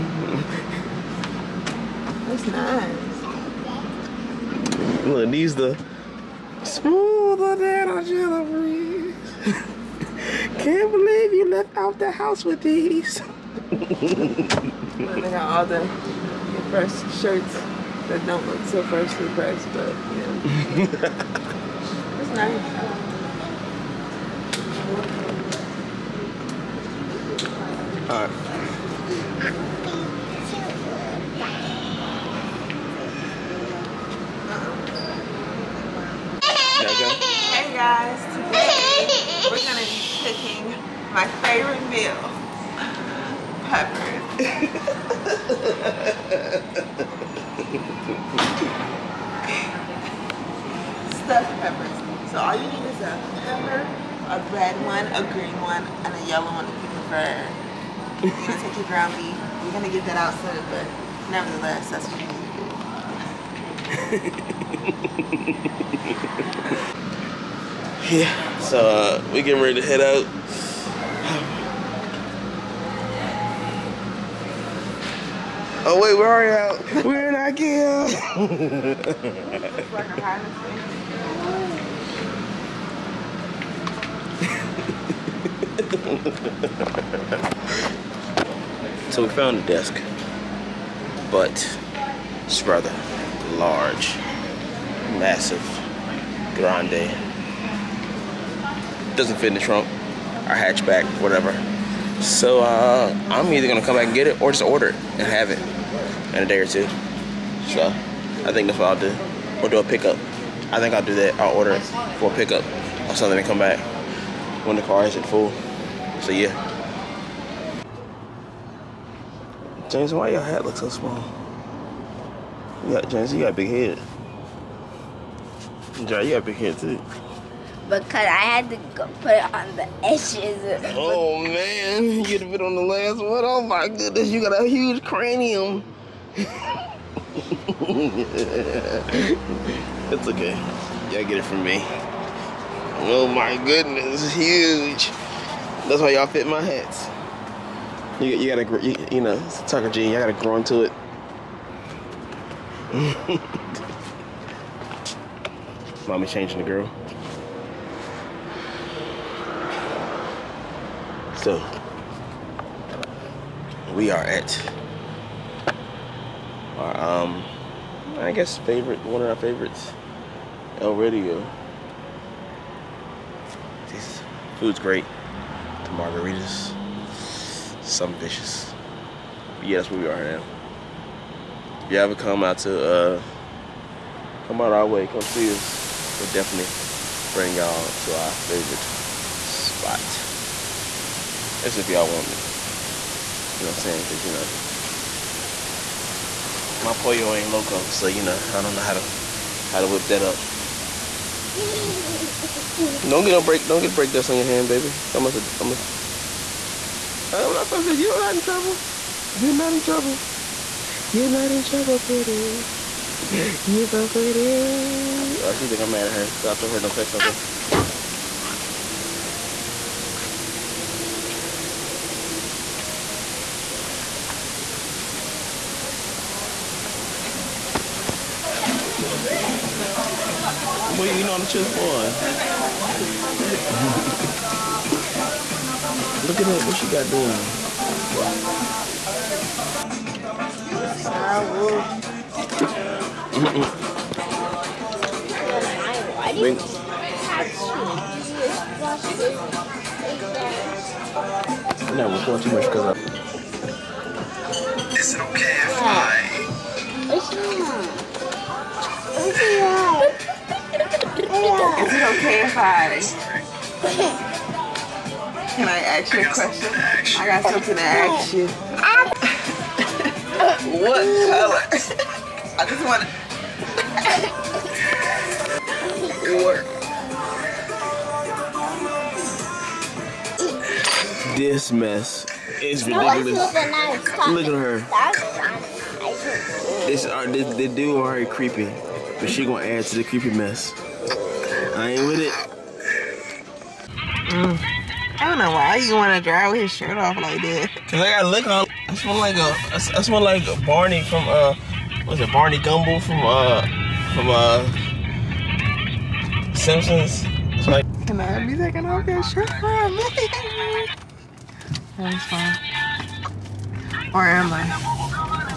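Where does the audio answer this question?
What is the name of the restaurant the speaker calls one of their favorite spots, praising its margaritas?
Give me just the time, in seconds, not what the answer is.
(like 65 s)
170 s.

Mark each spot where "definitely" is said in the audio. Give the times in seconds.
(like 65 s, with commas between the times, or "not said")
186 s.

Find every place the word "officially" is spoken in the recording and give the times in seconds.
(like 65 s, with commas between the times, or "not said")
not said.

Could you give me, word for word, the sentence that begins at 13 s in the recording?
Look, they got all the fresh shirts that don't look so freshly pressed, but yeah.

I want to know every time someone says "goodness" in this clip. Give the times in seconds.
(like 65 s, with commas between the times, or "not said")
133 s, 143 s.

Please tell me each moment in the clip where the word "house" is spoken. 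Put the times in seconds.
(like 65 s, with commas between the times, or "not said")
12 s.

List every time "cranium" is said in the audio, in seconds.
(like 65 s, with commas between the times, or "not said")
135 s.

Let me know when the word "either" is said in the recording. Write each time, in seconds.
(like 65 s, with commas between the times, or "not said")
103 s.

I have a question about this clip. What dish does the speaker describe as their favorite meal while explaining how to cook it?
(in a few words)
Stuffed peppers.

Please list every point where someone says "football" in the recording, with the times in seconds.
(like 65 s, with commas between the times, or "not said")
not said.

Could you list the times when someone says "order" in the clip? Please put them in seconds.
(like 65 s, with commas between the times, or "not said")
104 s, 111 s.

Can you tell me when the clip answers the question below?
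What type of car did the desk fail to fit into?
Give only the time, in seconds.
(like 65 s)
100 s.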